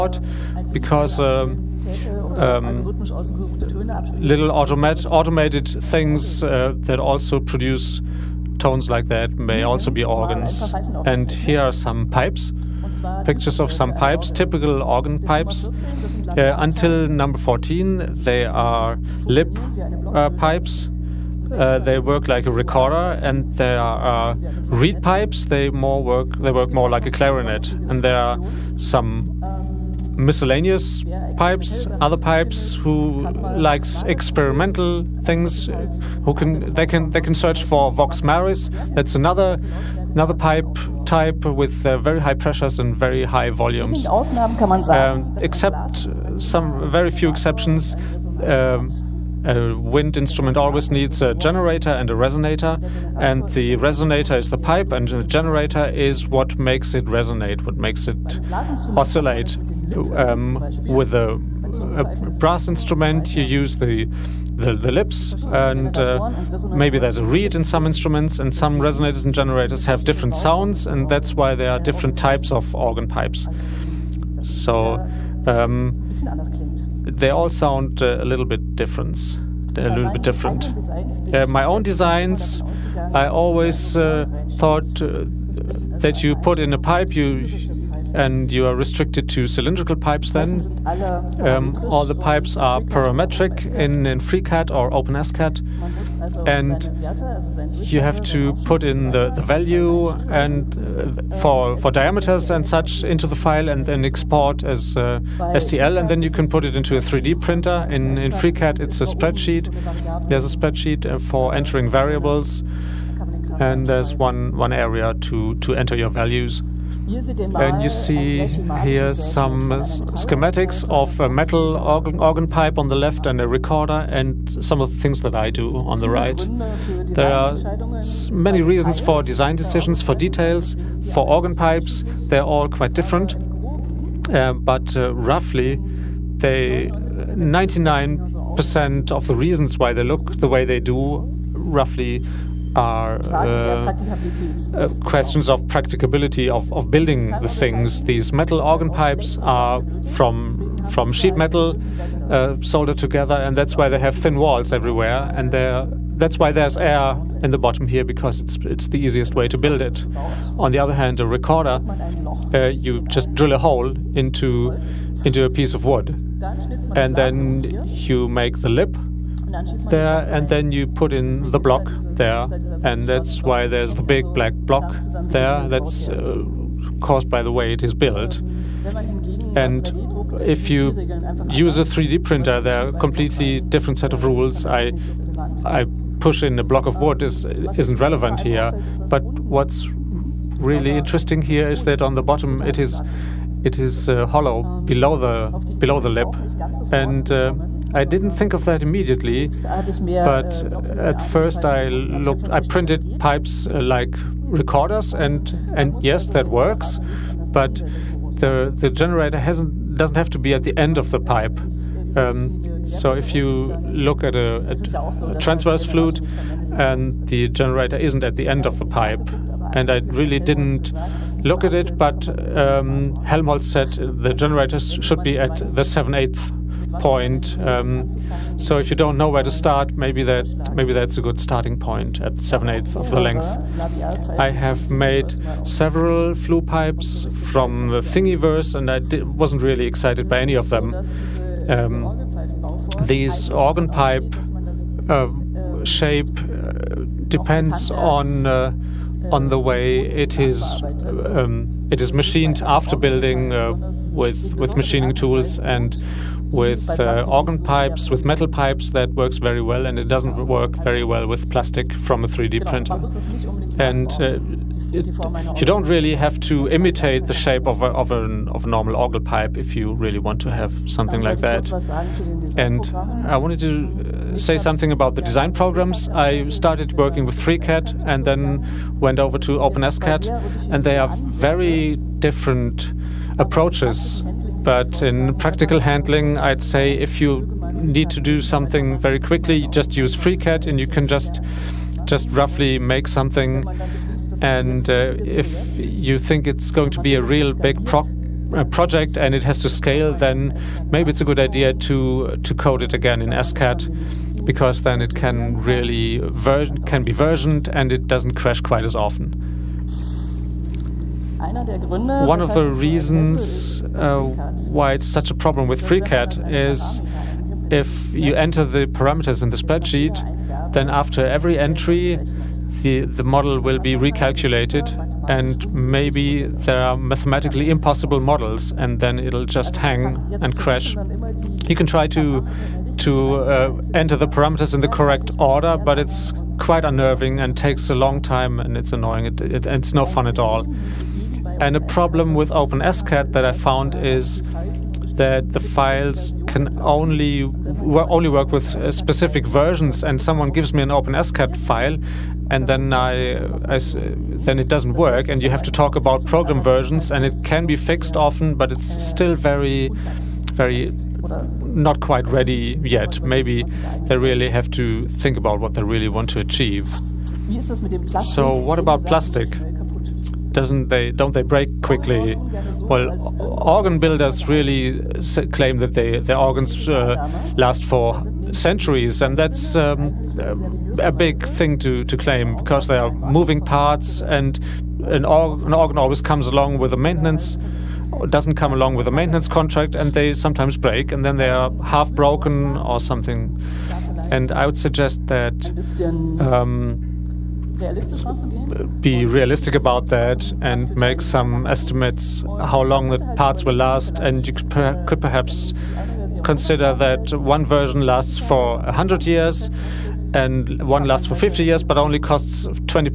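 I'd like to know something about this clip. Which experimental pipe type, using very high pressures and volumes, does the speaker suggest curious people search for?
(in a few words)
Vox Maris.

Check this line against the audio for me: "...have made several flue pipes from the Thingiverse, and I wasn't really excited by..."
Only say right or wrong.
right.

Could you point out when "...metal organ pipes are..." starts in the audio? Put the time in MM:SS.
02:28.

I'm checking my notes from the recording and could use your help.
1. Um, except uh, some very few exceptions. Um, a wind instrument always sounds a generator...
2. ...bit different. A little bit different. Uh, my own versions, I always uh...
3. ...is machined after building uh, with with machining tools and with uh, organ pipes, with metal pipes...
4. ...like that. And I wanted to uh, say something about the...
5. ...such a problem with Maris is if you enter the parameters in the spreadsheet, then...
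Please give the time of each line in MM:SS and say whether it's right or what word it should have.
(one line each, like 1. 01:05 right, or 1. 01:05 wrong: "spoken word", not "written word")
1. 00:44 wrong: "needs", not "sounds"
2. 01:18 wrong: "designs", not "versions"
3. 04:12 right
4. 04:31 right
5. 05:15 wrong: "FreeCAD", not "Maris".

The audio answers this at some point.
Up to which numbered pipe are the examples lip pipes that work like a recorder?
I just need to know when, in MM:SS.
00:17.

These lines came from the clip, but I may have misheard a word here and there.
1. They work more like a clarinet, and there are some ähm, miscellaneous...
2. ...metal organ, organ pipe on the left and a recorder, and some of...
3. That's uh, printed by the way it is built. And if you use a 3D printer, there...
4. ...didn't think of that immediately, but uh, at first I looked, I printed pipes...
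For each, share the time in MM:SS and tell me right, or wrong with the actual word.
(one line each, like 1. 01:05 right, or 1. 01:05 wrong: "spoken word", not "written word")
1. 00:26 right
2. 02:01 right
3. 02:55 wrong: "caused", not "printed"
4. 03:18 right.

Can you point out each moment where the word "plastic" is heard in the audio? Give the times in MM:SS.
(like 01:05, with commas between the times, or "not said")
04:21, 06:09.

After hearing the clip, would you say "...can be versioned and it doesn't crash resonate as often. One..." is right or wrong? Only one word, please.
wrong.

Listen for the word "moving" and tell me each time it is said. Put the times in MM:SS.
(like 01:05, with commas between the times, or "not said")
06:23.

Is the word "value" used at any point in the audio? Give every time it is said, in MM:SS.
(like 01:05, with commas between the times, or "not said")
01:39, 01:56.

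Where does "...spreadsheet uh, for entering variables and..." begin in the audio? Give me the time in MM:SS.
01:50.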